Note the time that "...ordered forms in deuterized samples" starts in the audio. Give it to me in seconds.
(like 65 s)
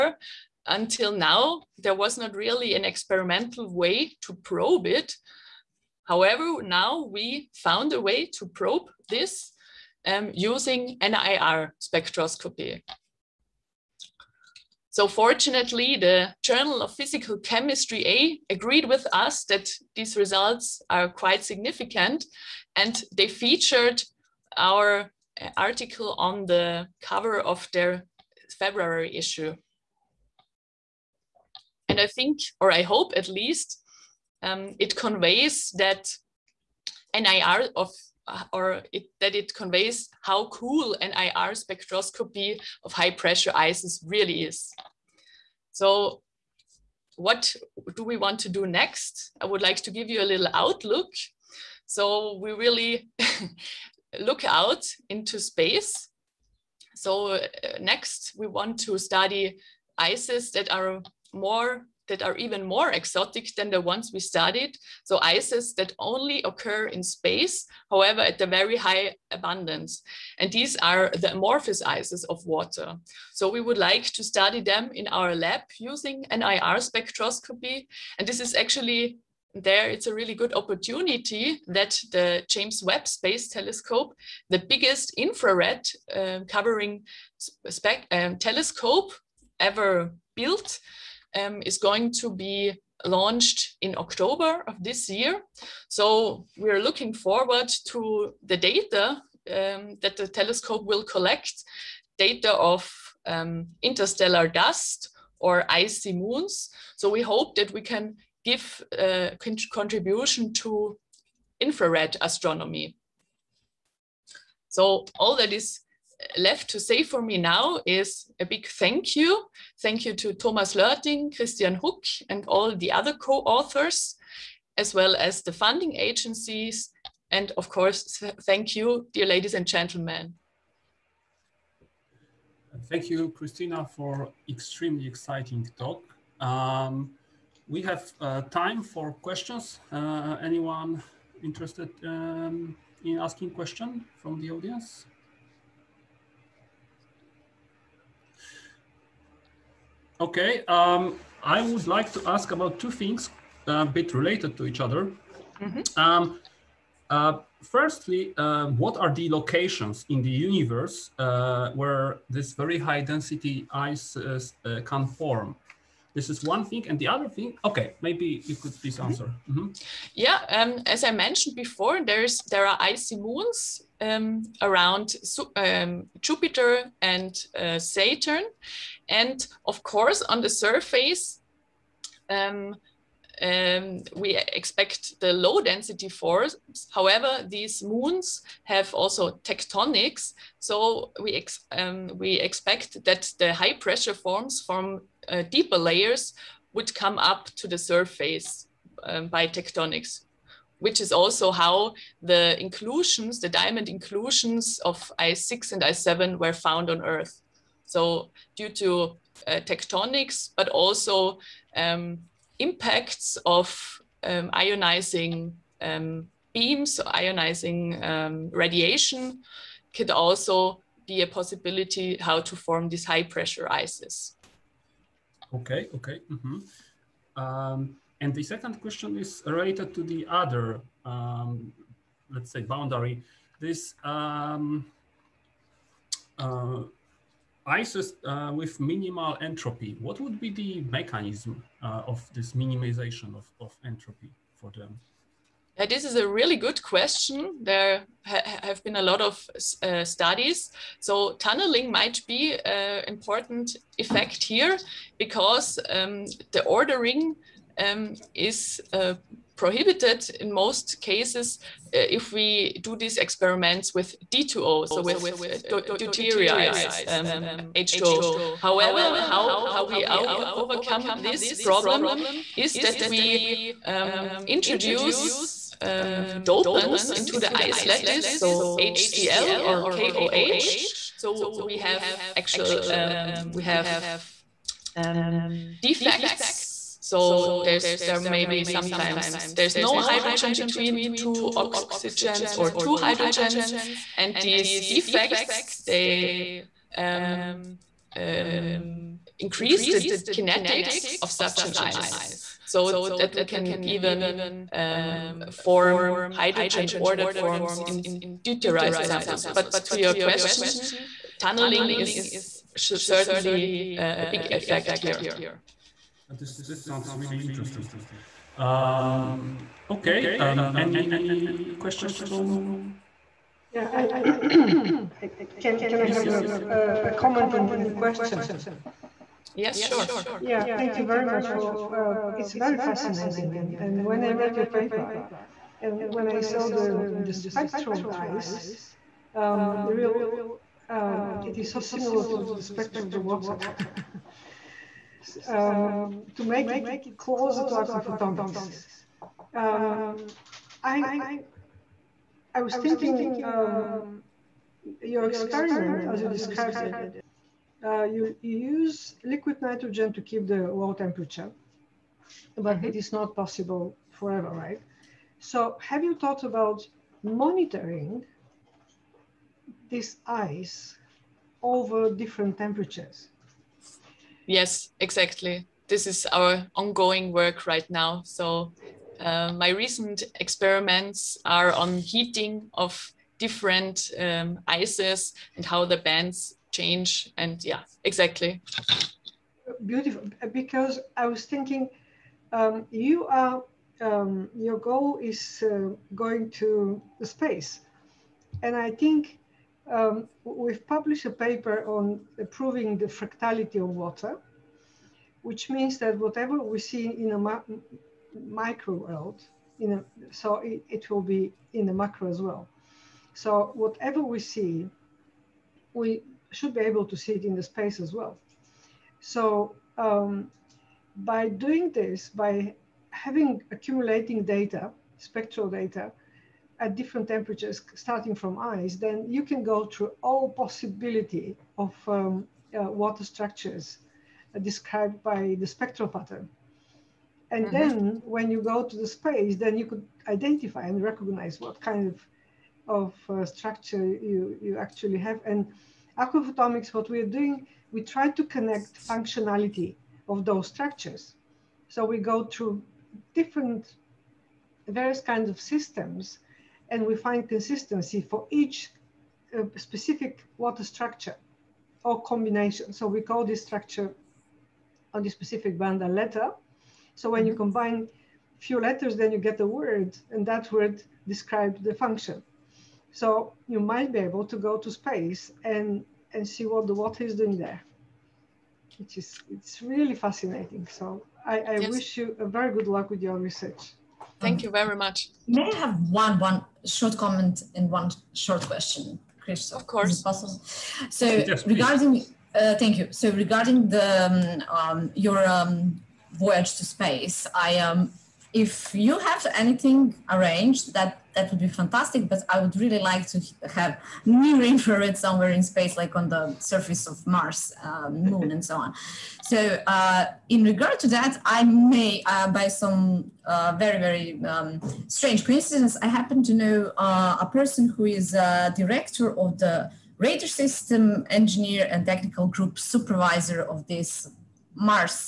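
306 s.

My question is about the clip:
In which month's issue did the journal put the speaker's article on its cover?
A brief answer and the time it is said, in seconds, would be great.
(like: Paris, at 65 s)
February, at 28 s.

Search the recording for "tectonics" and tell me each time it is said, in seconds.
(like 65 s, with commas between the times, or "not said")
189 s, 199 s, 209 s.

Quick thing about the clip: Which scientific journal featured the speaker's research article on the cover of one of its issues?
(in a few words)
Journal of Physical Chemistry A.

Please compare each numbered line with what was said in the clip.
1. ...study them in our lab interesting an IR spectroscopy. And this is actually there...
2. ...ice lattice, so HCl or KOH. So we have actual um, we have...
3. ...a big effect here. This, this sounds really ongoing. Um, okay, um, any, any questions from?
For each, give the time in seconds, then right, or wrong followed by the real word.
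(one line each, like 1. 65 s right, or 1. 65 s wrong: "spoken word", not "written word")
1. 74 s wrong: "using", not "interesting"
2. 277 s right
3. 314 s wrong: "interesting", not "ongoing".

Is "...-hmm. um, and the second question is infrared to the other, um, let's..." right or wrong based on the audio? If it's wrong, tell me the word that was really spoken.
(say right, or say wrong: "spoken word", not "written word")
wrong: "related", not "infrared".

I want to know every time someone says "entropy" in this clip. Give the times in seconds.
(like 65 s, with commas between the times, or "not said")
239 s, 243 s.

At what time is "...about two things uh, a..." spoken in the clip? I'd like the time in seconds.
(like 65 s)
152 s.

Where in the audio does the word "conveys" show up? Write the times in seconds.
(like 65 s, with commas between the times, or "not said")
34 s, 39 s.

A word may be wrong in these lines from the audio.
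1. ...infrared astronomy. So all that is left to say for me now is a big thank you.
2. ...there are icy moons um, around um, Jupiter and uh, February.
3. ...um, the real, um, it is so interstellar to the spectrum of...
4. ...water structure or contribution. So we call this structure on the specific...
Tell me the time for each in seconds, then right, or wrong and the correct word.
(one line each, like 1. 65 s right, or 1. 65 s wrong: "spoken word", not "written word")
1. 111 s right
2. 172 s wrong: "Saturn", not "February"
3. 339 s wrong: "similar", not "interstellar"
4. 460 s wrong: "combination", not "contribution".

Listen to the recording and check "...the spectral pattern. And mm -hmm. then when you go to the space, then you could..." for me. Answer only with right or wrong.
right.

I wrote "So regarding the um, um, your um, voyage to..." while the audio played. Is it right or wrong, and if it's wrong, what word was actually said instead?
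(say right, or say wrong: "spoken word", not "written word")
right.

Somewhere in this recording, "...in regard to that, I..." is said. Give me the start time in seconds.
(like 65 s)
510 s.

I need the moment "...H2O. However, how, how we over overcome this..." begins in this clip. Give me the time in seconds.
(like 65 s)
267 s.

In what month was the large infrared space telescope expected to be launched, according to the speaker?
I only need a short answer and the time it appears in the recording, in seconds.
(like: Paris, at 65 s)
October, at 93 s.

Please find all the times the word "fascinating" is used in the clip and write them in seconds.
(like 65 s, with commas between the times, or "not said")
332 s, 480 s.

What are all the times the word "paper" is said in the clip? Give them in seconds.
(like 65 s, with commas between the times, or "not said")
334 s, 401 s.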